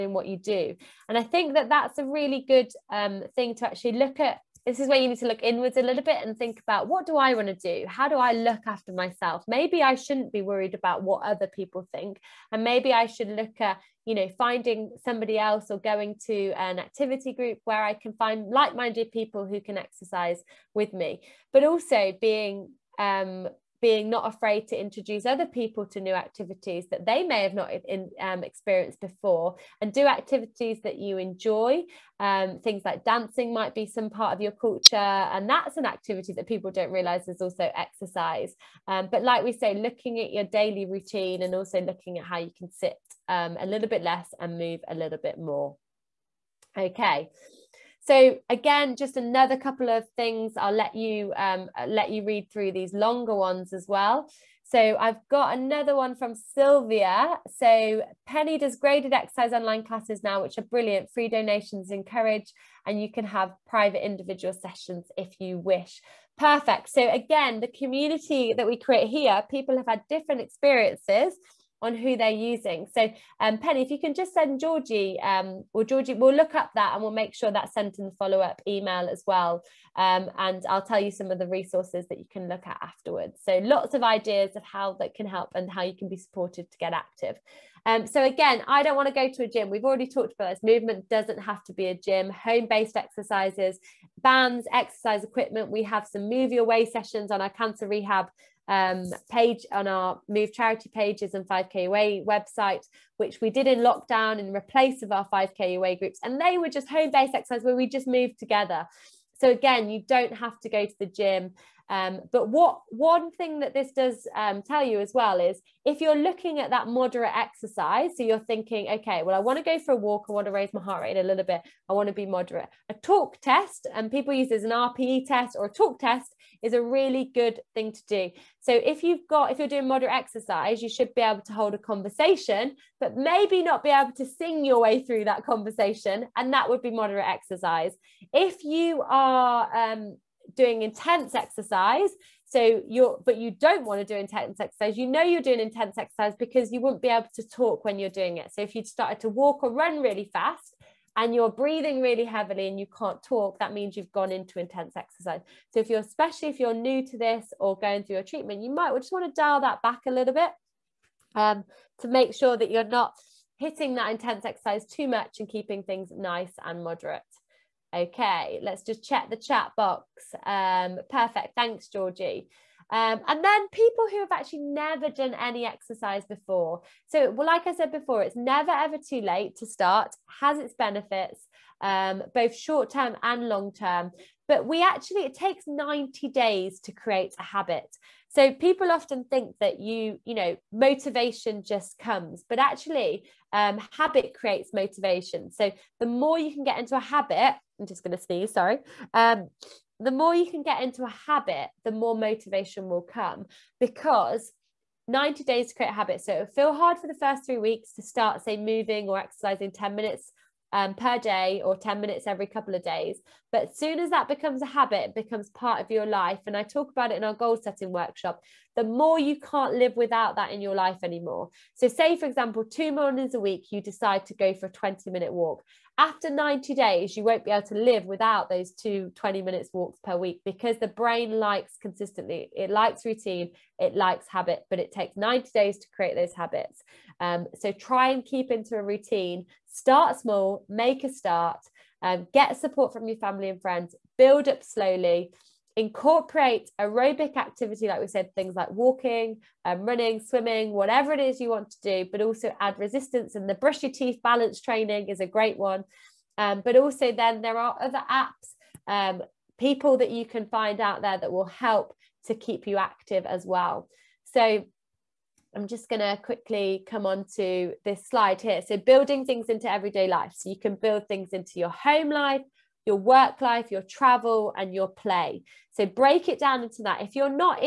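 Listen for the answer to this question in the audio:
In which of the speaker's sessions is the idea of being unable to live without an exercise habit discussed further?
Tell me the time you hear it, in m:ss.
3:37.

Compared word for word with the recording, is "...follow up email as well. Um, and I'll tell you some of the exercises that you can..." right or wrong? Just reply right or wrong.
wrong.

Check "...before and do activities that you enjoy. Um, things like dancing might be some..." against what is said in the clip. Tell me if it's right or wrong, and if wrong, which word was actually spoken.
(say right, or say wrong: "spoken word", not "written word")
right.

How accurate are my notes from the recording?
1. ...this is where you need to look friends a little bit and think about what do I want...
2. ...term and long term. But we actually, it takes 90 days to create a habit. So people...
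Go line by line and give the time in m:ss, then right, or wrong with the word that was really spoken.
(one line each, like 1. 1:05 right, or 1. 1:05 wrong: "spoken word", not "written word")
1. 0:04 wrong: "inwards", not "friends"
2. 3:02 right.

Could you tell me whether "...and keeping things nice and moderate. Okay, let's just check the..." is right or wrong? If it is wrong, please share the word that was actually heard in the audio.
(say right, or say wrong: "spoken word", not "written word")
right.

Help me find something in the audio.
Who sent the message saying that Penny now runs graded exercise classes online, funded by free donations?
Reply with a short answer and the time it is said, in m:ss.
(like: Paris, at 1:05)
Sylvia, at 0:56.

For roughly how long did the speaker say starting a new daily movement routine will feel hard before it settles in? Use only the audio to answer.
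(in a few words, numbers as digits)
3 weeks.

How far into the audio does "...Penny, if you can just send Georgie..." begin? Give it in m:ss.
1:13.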